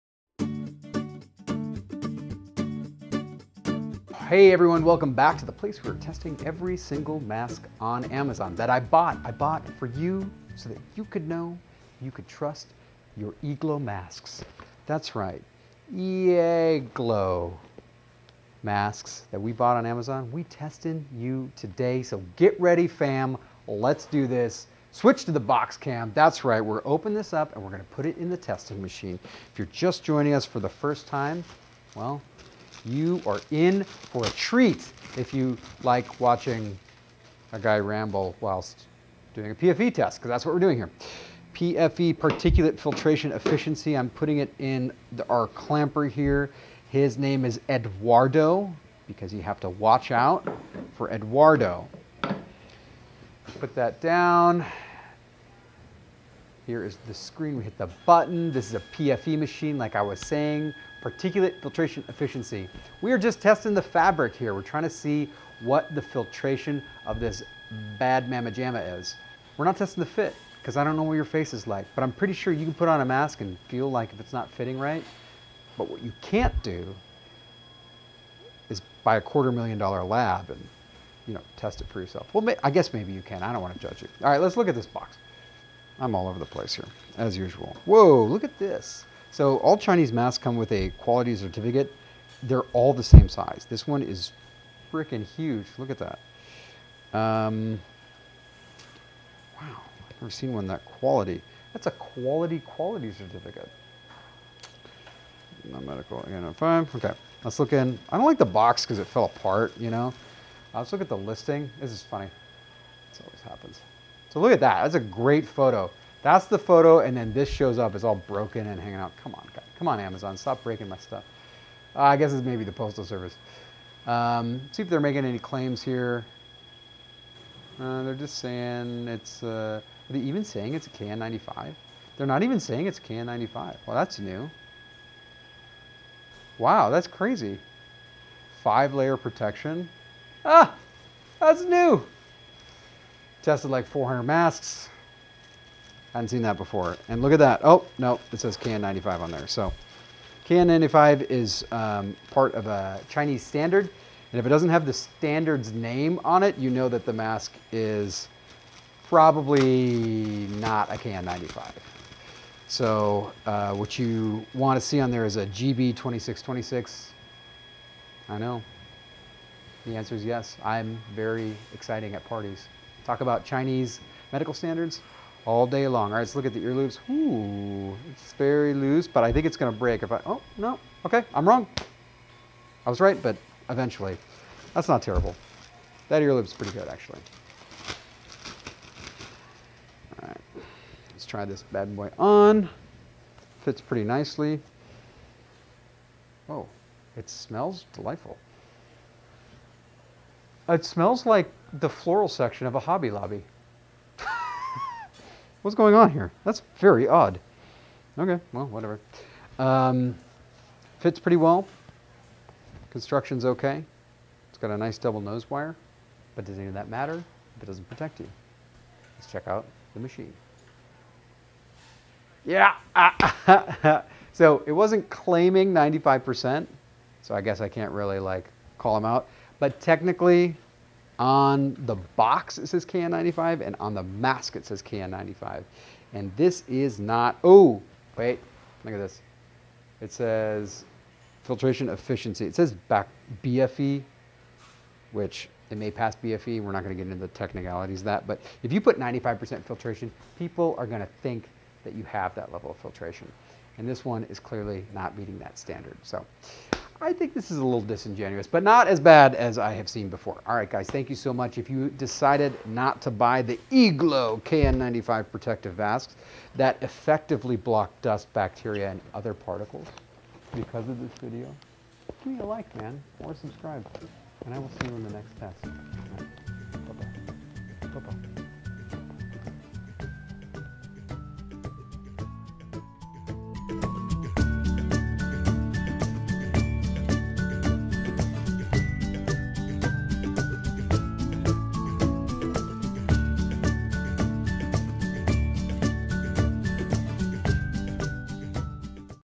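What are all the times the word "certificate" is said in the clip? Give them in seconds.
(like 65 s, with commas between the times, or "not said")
91 s, 103 s.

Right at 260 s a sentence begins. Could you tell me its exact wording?
All right, guys, thank you so much.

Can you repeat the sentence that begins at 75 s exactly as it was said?
But what you can't do is buy a quarter million dollar lab and you know, test it for yourself.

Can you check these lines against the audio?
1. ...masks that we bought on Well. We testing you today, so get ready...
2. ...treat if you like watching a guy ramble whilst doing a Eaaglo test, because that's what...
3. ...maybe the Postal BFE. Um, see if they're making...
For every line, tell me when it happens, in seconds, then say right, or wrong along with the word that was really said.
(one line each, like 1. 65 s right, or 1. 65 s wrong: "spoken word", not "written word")
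1. 18 s wrong: "Amazon", not "Well"
2. 34 s wrong: "PFE", not "Eaaglo"
3. 122 s wrong: "Service", not "BFE".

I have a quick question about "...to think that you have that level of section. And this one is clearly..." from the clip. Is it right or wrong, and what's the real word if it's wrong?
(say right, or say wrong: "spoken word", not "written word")
wrong: "filtration", not "section".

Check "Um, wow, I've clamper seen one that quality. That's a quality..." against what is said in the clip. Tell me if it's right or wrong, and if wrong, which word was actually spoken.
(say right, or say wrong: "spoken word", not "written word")
wrong: "never", not "clamper".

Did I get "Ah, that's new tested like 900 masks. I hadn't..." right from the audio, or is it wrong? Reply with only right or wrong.
wrong.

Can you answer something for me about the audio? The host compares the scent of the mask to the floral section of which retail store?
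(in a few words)
Hobby Lobby.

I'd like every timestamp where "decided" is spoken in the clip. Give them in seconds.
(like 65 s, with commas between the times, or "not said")
261 s.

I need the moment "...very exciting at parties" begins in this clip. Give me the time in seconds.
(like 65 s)
171 s.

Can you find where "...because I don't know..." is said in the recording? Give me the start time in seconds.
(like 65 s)
70 s.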